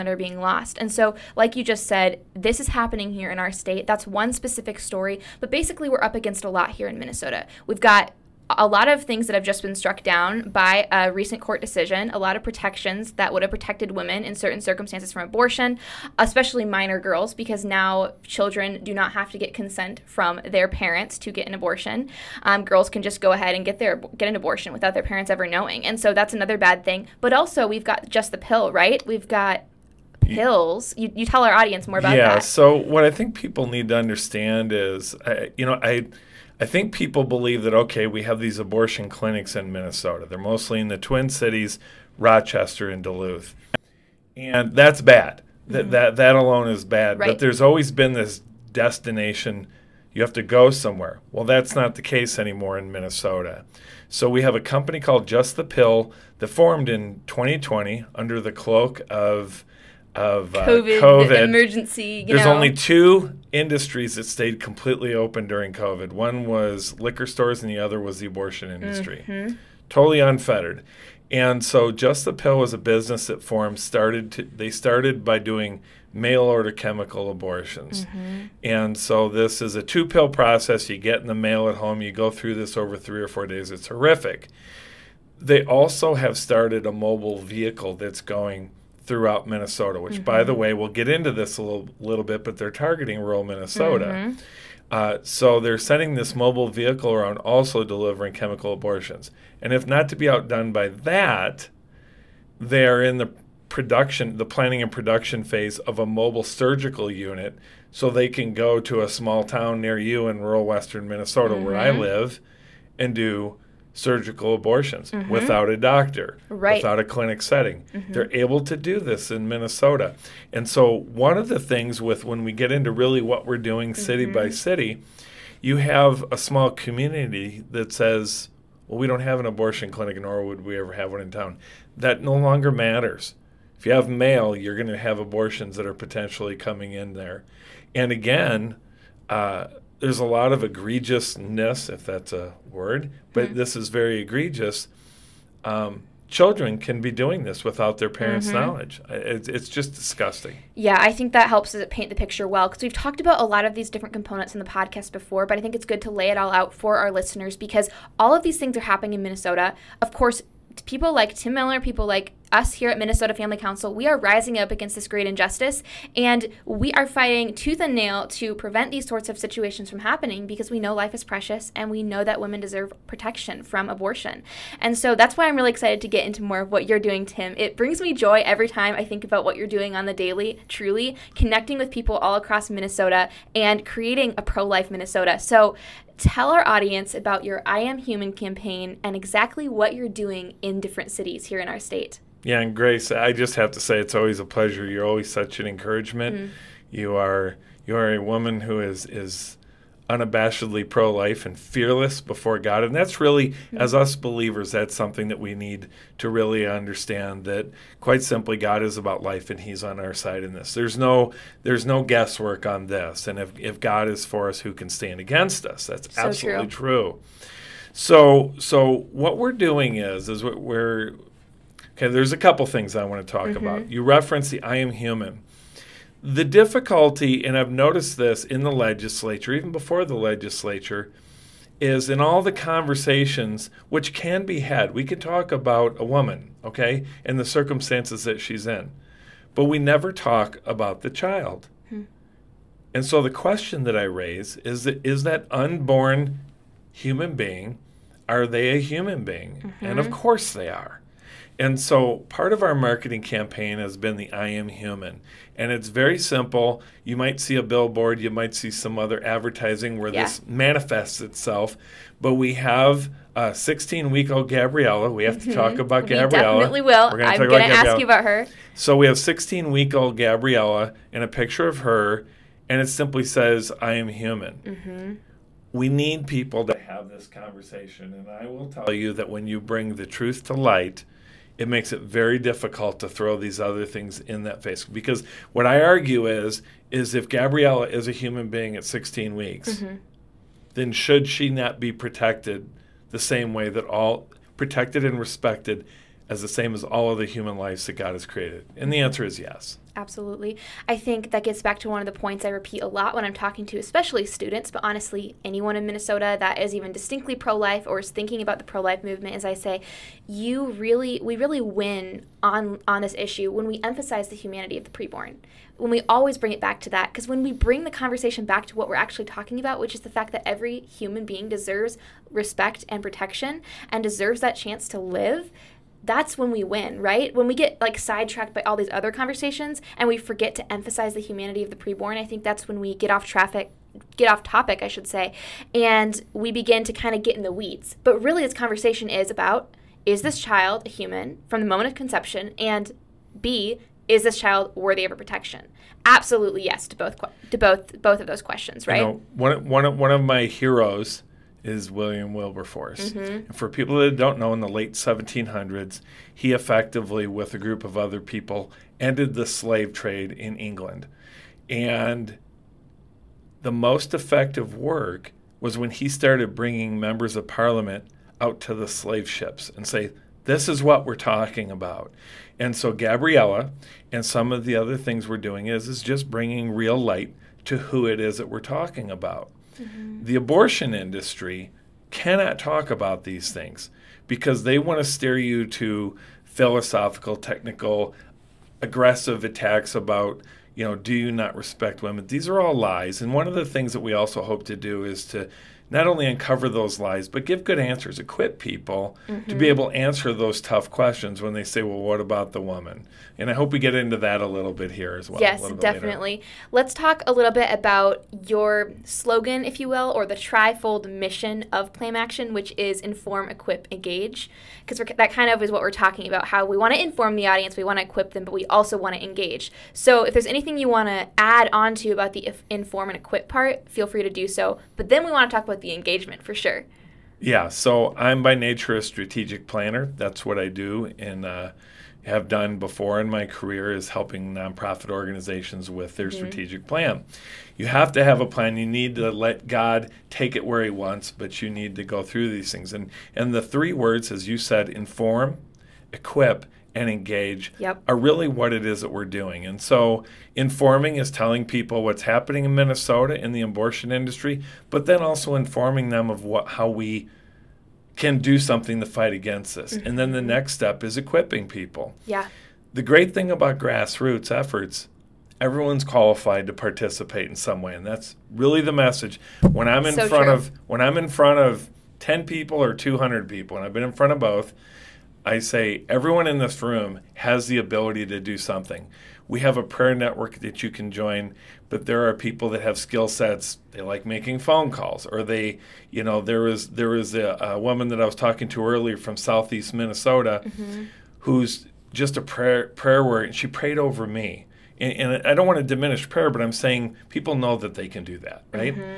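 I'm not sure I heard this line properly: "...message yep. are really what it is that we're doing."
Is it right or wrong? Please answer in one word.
wrong.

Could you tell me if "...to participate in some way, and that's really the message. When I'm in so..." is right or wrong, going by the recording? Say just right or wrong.
right.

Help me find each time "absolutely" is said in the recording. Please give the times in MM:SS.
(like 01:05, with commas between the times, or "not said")
03:36, 04:59, 05:46.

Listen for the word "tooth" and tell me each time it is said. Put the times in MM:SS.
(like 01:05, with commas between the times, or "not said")
02:47.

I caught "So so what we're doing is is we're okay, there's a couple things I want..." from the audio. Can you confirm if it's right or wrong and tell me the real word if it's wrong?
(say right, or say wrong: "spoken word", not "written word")
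right.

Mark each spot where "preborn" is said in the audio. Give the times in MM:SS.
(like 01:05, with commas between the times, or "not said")
05:14, 05:31.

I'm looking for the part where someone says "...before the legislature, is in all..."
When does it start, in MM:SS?
03:49.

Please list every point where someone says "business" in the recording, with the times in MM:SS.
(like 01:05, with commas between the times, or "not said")
01:12.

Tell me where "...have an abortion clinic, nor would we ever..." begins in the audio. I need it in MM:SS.
02:09.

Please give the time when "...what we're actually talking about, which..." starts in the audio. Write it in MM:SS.
05:18.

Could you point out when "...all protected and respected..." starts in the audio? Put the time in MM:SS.
04:53.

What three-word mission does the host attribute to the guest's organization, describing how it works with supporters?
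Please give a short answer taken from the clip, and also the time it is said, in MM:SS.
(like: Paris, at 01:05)
Inform, equip, engage, at 06:53.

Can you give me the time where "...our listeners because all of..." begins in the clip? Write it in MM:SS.
02:36.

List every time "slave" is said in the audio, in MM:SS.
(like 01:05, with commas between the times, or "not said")
05:59, 06:08.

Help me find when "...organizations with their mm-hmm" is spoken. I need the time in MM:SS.
07:15.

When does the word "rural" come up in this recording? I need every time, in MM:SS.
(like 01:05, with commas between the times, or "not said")
01:33, 01:50.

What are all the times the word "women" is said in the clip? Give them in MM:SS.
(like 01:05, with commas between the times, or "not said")
00:13, 02:52, 06:32.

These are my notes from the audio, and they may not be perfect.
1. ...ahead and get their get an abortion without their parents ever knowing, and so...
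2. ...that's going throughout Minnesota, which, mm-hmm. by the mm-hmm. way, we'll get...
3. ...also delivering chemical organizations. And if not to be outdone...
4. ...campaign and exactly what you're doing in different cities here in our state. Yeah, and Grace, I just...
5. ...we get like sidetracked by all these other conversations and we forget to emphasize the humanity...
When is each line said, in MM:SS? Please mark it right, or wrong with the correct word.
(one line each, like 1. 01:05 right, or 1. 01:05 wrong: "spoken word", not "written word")
1. 00:23 right
2. 01:27 right
3. 01:37 wrong: "abortions", not "organizations"
4. 03:08 right
5. 05:27 right.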